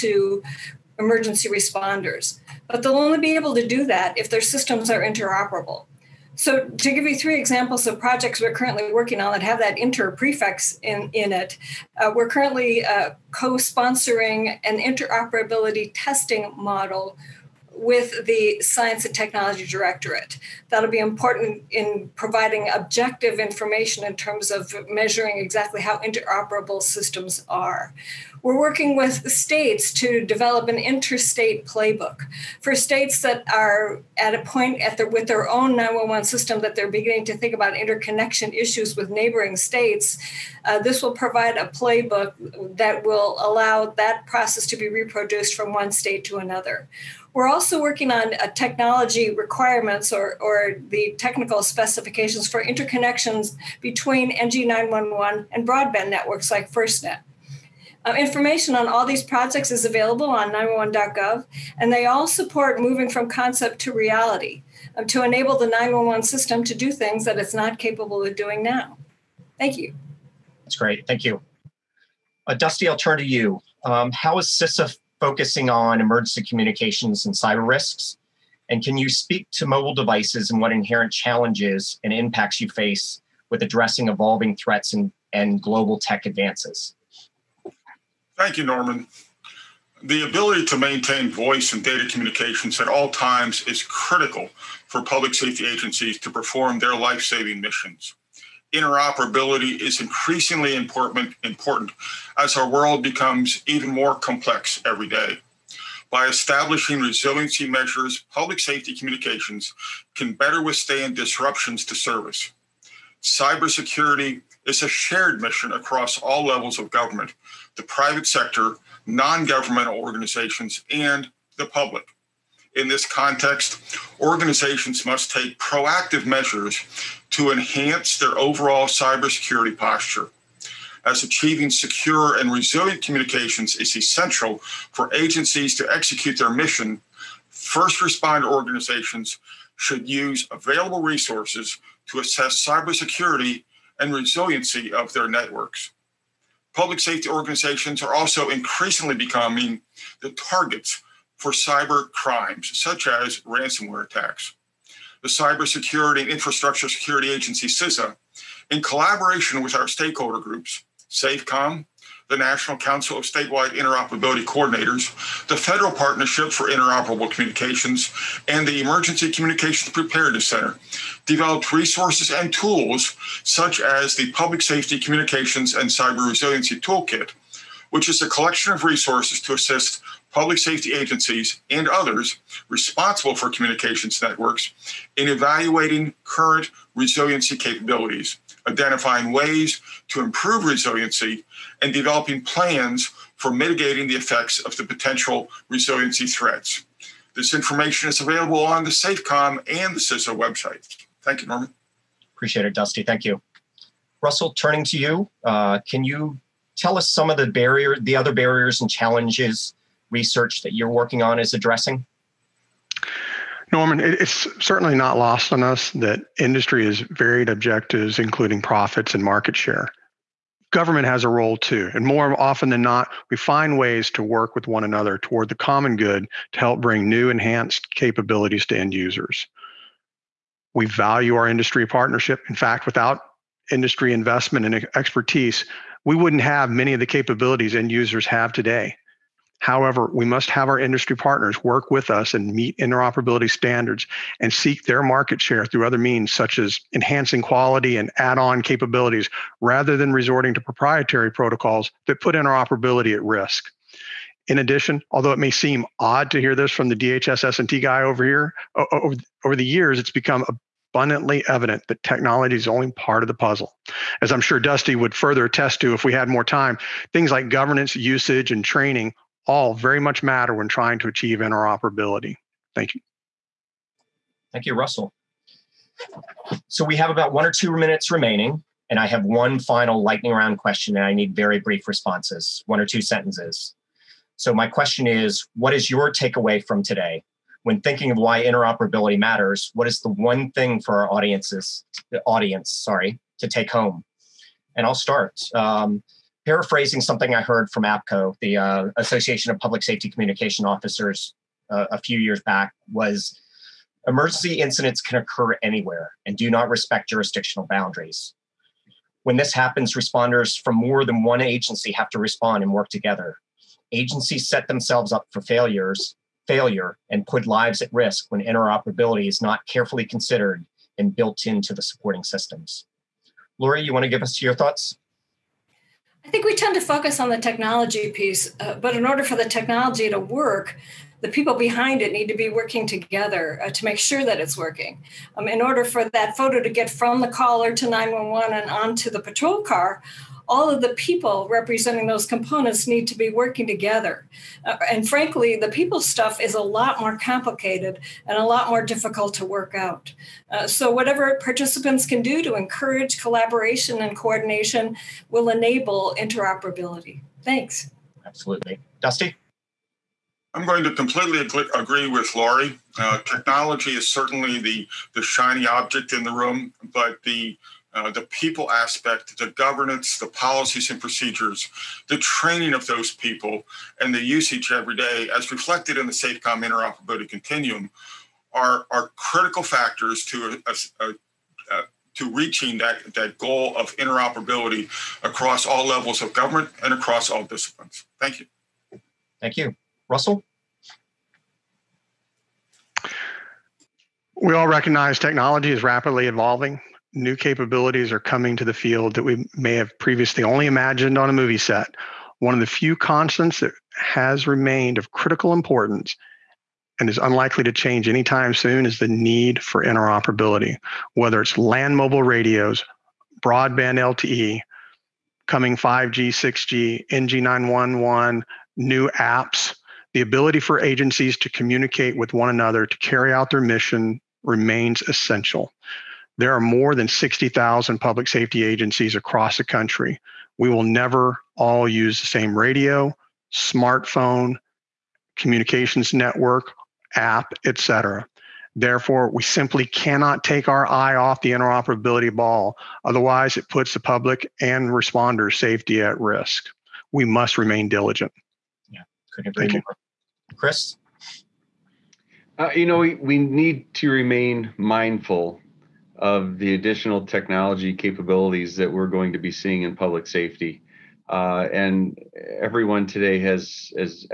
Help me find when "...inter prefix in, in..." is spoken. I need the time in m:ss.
0:09.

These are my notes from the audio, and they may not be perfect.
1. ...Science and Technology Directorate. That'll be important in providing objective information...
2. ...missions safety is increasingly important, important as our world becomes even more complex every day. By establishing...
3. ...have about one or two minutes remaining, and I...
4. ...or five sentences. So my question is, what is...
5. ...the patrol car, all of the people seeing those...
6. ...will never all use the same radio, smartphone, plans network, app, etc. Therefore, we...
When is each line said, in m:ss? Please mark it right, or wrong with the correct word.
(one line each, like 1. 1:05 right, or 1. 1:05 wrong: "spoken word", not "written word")
1. 0:18 right
2. 1:37 wrong: "interoperability", not "safety"
3. 4:36 right
4. 4:42 wrong: "two", not "five"
5. 5:39 wrong: "representing", not "seeing"
6. 7:10 wrong: "communications", not "plans".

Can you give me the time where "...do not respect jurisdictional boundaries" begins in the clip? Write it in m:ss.
5:06.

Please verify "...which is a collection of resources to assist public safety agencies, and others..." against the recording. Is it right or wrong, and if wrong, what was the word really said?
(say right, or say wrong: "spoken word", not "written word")
right.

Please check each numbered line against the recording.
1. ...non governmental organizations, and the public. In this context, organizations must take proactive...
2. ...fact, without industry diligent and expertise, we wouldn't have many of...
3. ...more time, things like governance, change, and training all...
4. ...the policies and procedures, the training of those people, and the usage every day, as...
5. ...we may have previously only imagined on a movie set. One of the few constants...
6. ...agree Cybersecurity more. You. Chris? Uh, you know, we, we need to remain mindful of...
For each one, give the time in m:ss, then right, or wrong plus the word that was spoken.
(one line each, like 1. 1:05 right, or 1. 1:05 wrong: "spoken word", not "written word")
1. 1:59 right
2. 3:52 wrong: "investment", not "diligent"
3. 4:26 wrong: "usage", not "change"
4. 6:10 right
5. 6:39 right
6. 7:29 wrong: "Thank", not "Cybersecurity".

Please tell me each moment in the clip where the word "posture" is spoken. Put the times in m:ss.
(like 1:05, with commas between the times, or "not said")
2:09.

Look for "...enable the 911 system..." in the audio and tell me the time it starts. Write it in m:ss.
1:05.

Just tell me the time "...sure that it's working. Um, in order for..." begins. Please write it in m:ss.
5:33.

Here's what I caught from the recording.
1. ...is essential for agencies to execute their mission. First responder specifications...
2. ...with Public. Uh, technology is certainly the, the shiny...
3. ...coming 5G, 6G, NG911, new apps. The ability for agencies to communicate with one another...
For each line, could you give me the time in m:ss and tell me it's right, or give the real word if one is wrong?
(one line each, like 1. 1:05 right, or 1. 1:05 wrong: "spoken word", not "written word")
1. 2:13 wrong: "organizations", not "specifications"
2. 6:02 wrong: "Laurie", not "Public"
3. 6:55 right.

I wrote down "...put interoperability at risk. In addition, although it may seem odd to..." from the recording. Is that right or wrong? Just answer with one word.
right.